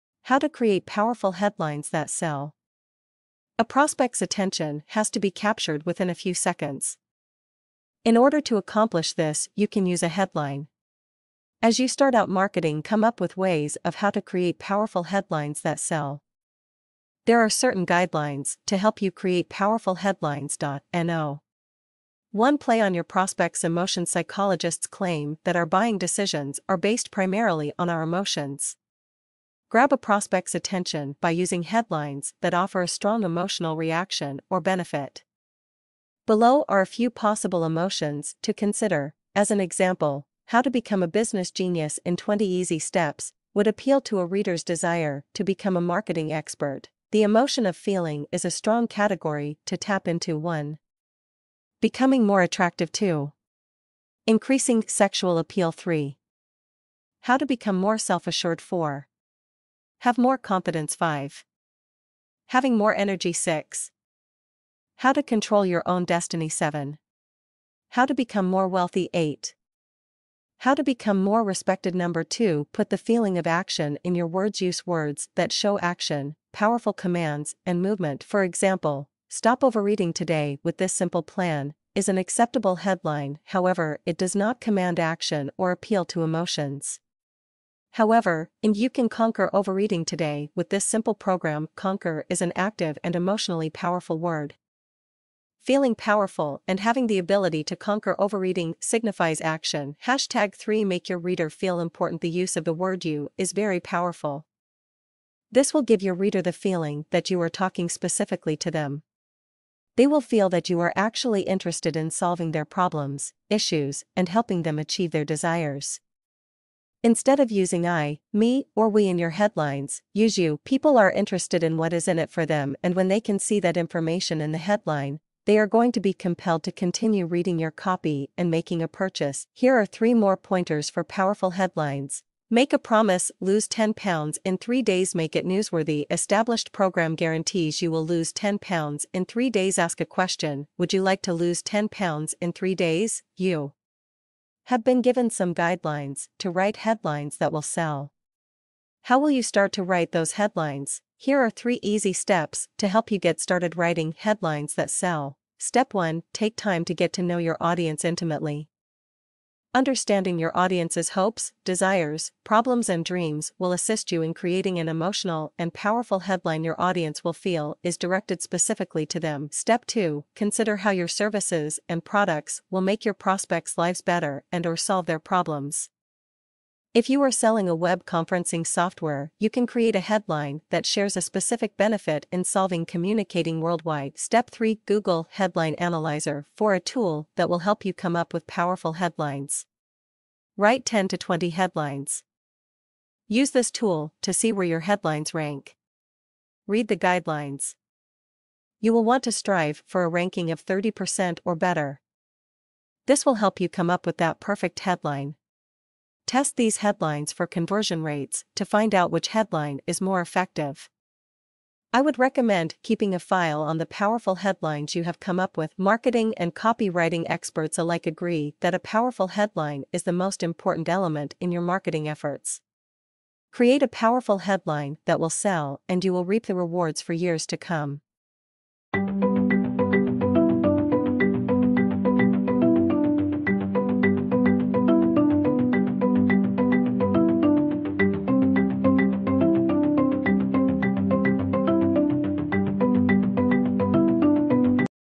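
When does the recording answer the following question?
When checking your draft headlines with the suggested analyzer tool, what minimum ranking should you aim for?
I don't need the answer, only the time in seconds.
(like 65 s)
200 s.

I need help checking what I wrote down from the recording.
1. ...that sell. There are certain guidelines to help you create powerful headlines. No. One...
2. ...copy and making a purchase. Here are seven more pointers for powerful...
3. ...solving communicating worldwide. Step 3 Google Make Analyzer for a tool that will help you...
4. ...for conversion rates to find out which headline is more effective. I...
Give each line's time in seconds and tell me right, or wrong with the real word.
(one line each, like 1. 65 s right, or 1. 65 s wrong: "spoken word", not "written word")
1. 15 s right
2. 127 s wrong: "three", not "seven"
3. 182 s wrong: "Headline", not "Make"
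4. 207 s right.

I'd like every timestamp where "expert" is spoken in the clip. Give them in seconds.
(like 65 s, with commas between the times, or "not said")
46 s, 217 s.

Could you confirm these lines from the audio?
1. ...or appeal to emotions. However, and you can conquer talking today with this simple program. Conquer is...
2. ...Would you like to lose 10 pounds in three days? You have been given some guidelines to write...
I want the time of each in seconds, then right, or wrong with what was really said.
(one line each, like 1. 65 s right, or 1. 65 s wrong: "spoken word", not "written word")
1. 85 s wrong: "overeating", not "talking"
2. 140 s right.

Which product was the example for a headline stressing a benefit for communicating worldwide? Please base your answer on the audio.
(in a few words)
Web conferencing software.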